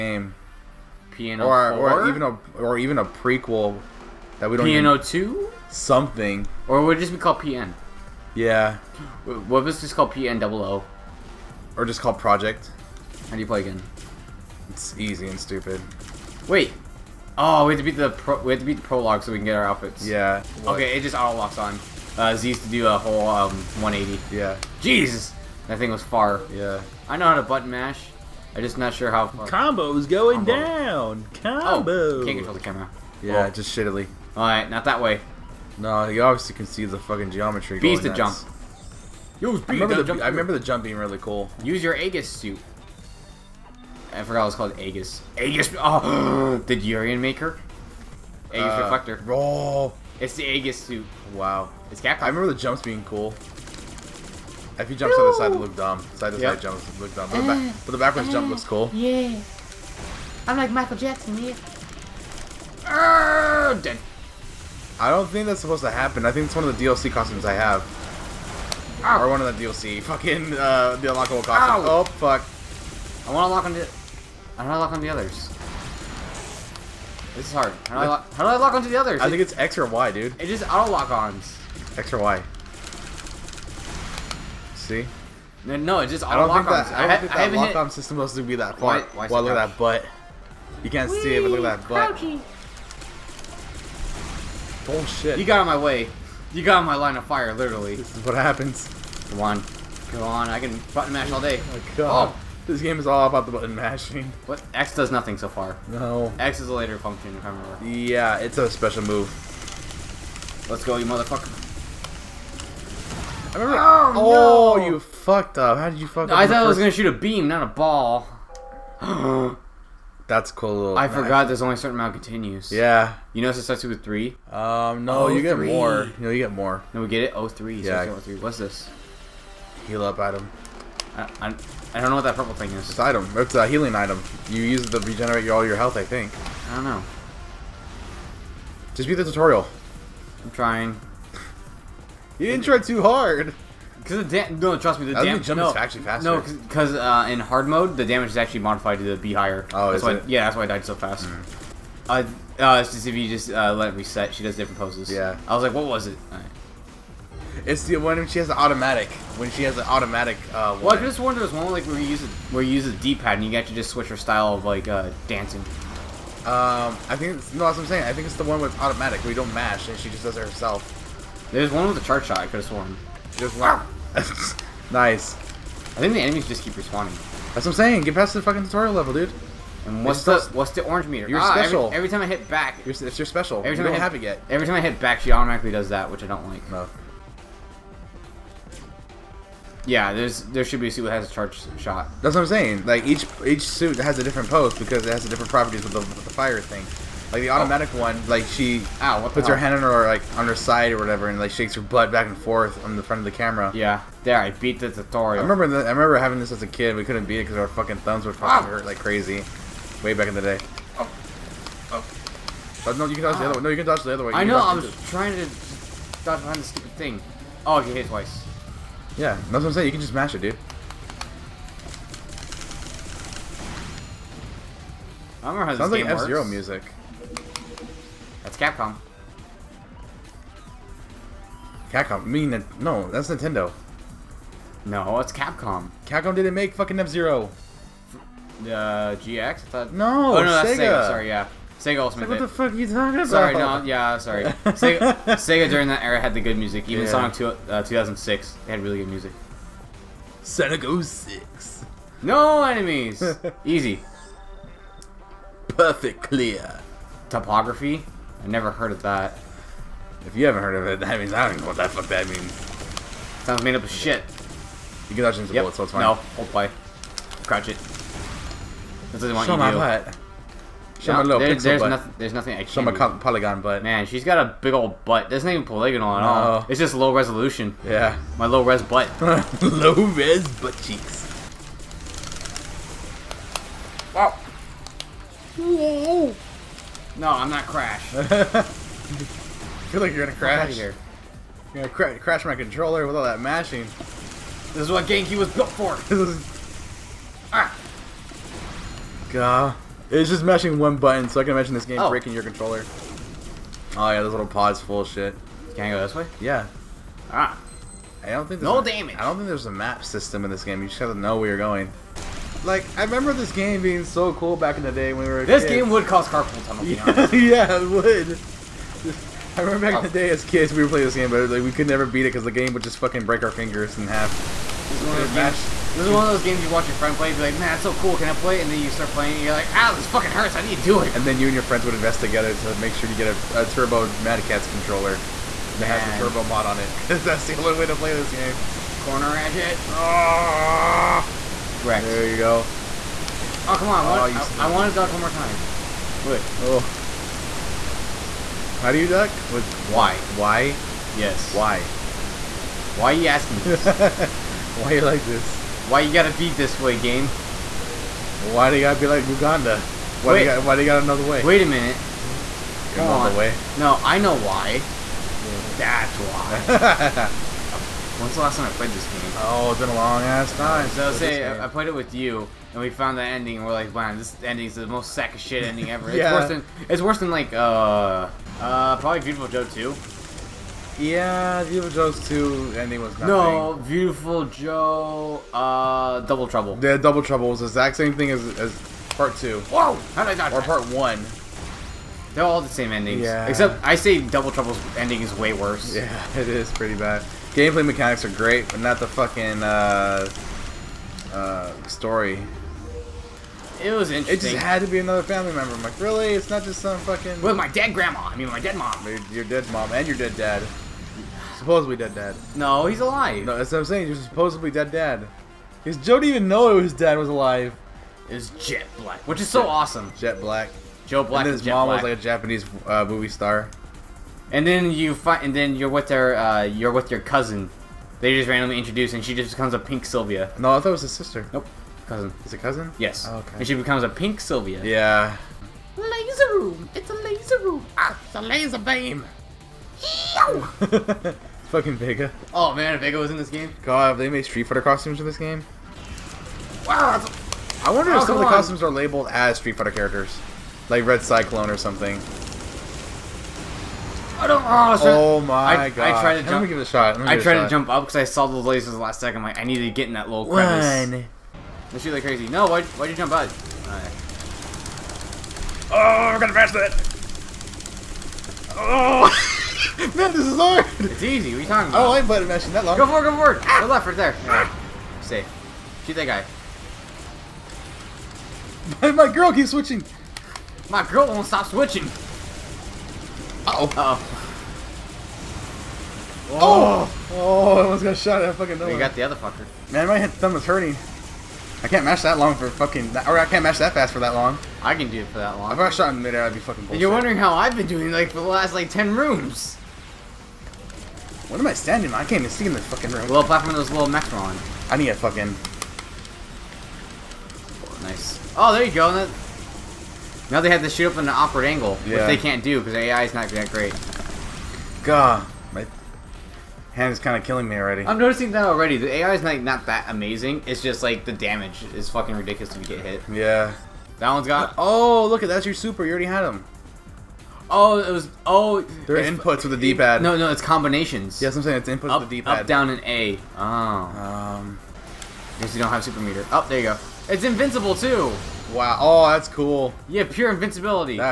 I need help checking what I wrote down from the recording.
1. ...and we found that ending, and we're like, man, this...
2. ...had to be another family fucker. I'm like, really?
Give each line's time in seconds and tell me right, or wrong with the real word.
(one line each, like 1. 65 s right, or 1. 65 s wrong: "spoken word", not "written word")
1. 372 s right
2. 404 s wrong: "member", not "fucker".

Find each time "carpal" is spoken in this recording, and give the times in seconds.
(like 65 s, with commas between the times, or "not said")
316 s.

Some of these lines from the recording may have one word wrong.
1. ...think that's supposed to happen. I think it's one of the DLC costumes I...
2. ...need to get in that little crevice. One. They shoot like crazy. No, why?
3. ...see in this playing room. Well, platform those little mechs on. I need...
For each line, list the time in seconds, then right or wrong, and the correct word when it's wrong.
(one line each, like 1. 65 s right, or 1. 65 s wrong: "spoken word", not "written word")
1. 65 s right
2. 459 s right
3. 502 s wrong: "fucking", not "playing".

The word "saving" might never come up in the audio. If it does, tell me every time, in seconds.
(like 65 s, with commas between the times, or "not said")
not said.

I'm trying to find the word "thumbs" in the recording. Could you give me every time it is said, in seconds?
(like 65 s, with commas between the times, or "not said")
207 s, 490 s.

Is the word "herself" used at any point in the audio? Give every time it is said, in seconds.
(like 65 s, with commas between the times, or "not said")
170 s.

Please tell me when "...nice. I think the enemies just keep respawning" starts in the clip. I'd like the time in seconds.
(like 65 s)
174 s.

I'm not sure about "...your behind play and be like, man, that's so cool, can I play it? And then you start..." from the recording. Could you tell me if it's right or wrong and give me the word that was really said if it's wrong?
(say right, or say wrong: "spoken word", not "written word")
wrong: "friend", not "behind".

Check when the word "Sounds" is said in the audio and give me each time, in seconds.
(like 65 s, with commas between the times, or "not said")
225 s, 263 s.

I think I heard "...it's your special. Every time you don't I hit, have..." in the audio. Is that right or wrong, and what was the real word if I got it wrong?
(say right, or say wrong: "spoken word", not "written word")
right.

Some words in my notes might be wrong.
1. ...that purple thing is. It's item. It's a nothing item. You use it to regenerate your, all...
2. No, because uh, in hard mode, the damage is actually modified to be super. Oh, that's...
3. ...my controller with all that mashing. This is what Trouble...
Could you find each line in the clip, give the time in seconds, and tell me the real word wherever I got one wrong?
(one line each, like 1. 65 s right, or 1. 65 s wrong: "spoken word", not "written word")
1. 132 s wrong: "healing", not "nothing"
2. 146 s wrong: "higher", not "super"
3. 292 s wrong: "GameCube", not "Trouble".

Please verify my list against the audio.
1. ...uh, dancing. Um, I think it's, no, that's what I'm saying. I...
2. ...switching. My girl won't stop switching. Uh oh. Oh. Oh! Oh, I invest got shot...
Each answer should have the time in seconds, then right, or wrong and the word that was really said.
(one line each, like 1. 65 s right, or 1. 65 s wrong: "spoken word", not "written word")
1. 164 s right
2. 479 s wrong: "almost", not "invest".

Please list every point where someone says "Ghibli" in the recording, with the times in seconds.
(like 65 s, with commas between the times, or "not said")
not said.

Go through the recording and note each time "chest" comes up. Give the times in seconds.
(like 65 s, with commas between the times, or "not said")
not said.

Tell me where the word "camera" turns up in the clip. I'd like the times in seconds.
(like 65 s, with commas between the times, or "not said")
32 s, 203 s.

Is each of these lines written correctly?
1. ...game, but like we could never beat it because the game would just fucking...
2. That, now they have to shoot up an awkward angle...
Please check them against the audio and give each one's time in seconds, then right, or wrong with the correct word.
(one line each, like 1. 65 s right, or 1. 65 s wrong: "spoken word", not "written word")
1. 321 s right
2. 509 s right.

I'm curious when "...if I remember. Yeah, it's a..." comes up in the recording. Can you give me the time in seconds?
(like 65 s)
107 s.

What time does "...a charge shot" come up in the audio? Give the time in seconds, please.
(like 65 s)
191 s.